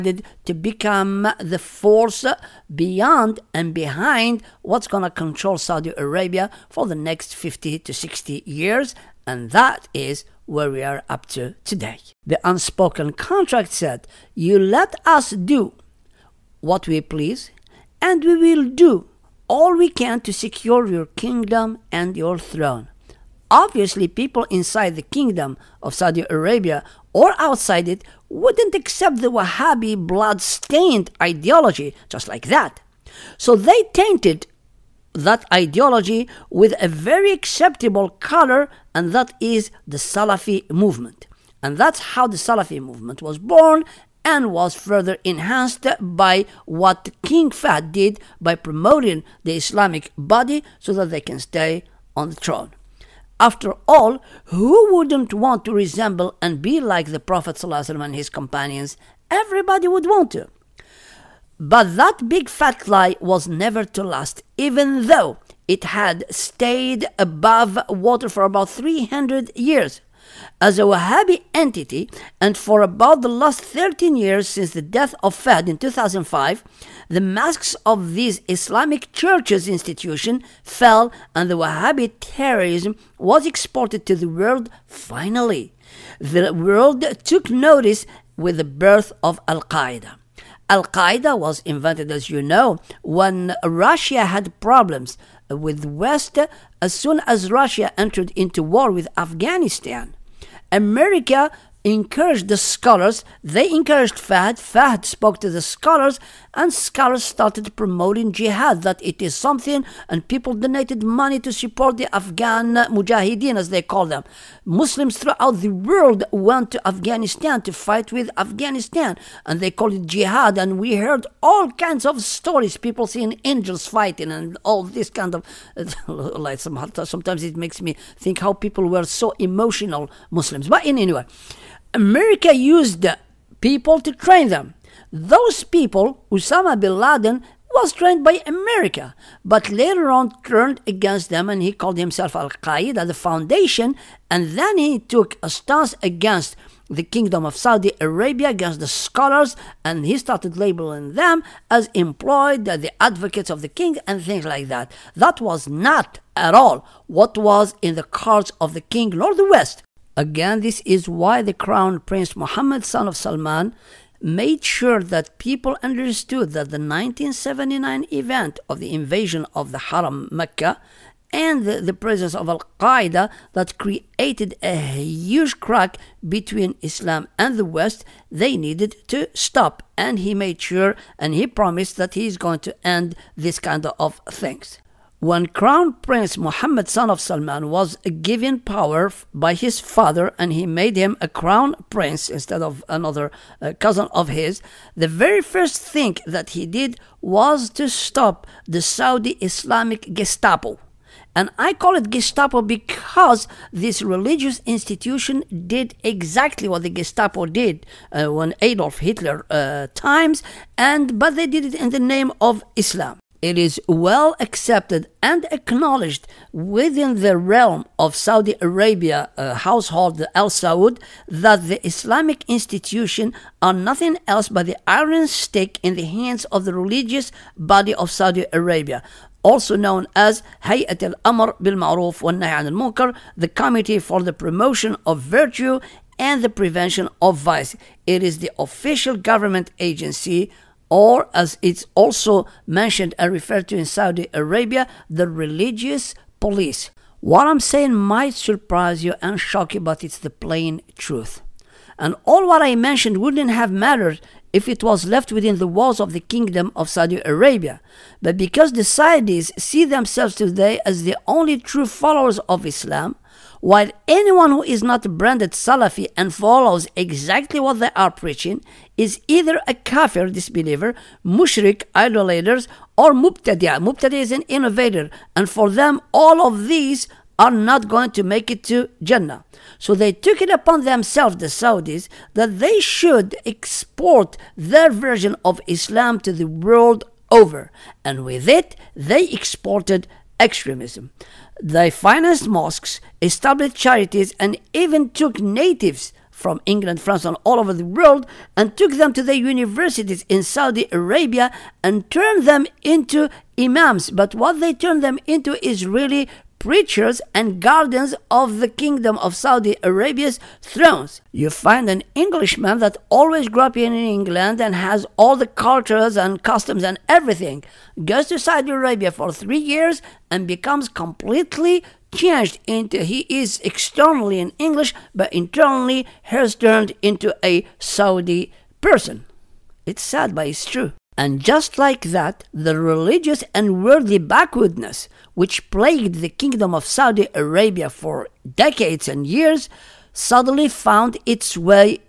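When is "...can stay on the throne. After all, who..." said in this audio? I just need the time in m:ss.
0:51.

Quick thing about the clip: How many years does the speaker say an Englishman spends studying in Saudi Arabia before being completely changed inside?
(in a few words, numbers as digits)
3.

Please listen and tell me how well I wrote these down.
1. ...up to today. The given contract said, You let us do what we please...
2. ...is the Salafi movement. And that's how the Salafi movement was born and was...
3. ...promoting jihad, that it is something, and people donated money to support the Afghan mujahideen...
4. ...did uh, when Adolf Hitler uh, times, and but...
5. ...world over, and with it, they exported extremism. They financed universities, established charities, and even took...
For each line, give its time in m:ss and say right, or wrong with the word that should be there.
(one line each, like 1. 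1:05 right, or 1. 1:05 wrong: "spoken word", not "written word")
1. 0:11 wrong: "unspoken", not "given"
2. 0:39 right
3. 1:47 right
4. 3:27 right
5. 4:46 wrong: "mosques", not "universities".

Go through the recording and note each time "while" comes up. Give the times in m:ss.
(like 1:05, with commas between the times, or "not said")
4:23.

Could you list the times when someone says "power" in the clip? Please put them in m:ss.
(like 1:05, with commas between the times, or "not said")
3:08.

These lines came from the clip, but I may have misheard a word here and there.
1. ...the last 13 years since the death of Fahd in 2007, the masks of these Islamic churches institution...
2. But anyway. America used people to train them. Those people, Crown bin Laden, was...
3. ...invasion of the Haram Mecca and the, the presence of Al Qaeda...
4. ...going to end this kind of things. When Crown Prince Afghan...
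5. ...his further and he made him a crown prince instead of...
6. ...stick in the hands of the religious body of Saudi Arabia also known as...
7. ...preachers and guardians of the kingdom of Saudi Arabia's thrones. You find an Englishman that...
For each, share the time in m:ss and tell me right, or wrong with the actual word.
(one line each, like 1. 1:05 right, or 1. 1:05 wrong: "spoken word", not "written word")
1. 1:13 wrong: "2005", not "2007"
2. 2:10 wrong: "Osama", not "Crown"
3. 2:48 right
4. 3:02 wrong: "Mohammed", not "Afghan"
5. 3:09 wrong: "father", not "further"
6. 3:45 right
7. 5:06 right.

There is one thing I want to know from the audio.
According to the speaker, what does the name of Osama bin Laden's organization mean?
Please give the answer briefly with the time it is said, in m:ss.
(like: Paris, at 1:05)
the foundation, at 2:23.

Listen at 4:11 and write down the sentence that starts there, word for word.
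And all what I mentioned wouldn't have mattered if it was left within the walls of the kingdom of Saudi Arabia.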